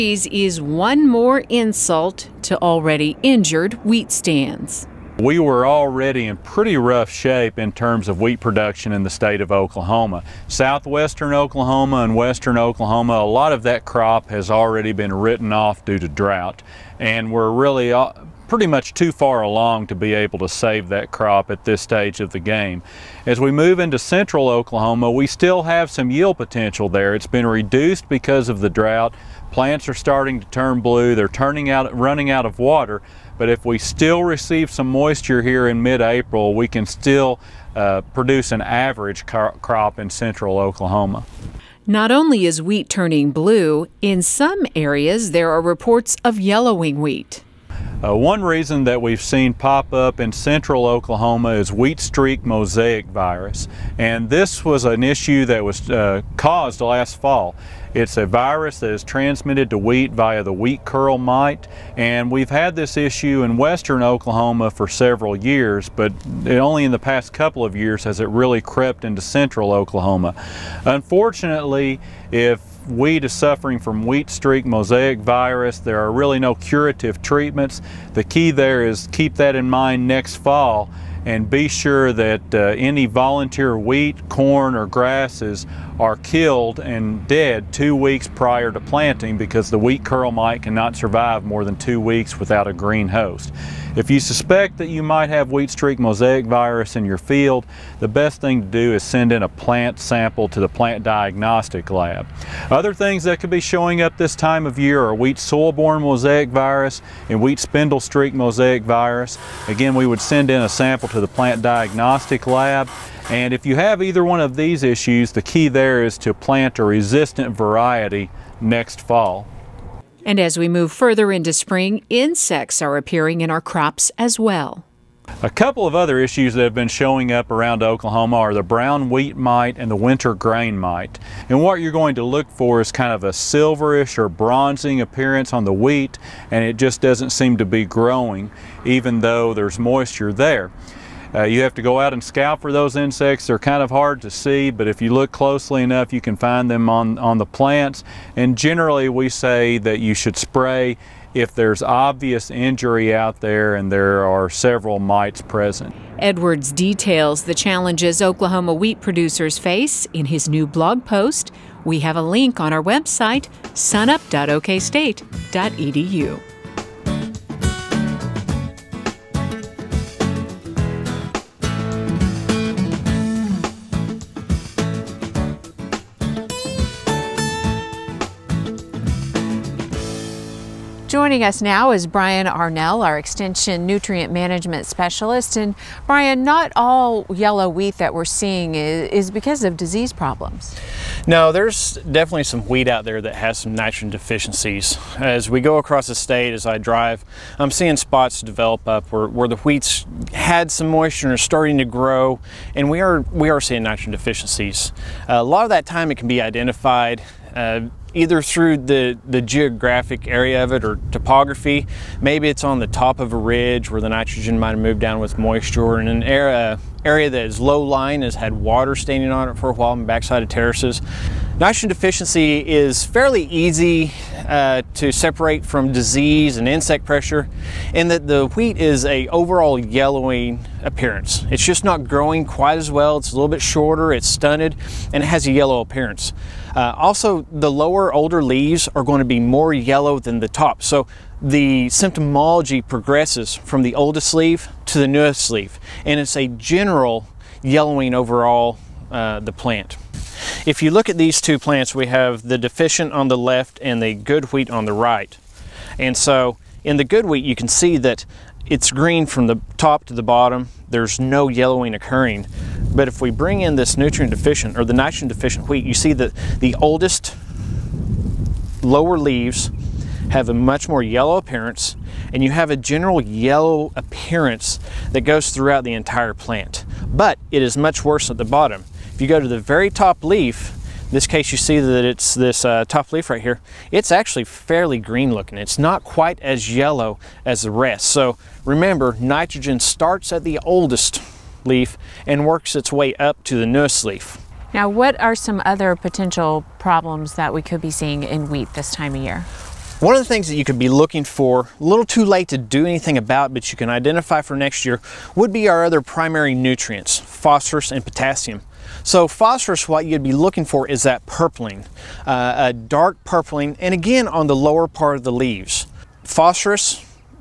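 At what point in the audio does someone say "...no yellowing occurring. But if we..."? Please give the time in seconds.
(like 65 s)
261 s.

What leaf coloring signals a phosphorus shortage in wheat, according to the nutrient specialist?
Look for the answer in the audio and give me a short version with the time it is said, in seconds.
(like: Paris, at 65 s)
dark purpling, at 312 s.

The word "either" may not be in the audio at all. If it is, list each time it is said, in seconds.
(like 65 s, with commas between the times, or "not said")
114 s, 208 s.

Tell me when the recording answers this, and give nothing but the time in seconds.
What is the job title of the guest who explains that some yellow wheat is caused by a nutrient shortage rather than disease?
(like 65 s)
183 s.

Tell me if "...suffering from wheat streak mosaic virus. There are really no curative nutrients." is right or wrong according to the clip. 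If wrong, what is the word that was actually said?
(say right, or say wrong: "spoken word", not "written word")
wrong: "treatments", not "nutrients".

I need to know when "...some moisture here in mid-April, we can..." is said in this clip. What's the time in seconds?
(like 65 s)
34 s.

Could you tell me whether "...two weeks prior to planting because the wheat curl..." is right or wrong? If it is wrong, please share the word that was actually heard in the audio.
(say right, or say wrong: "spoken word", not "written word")
right.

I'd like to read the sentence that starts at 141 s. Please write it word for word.
Uh, you have to go out and scout for those insects.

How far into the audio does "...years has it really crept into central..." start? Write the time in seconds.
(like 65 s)
67 s.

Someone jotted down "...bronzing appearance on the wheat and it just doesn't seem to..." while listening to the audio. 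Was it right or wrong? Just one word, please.
right.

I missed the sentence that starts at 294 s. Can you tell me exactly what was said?
Now, what are some other potential problems that we could be seeing in wheat this time of year?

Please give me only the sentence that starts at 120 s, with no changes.
And as we move further into spring, insects are appearing in our crops as well.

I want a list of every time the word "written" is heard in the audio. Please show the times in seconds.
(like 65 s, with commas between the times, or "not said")
15 s.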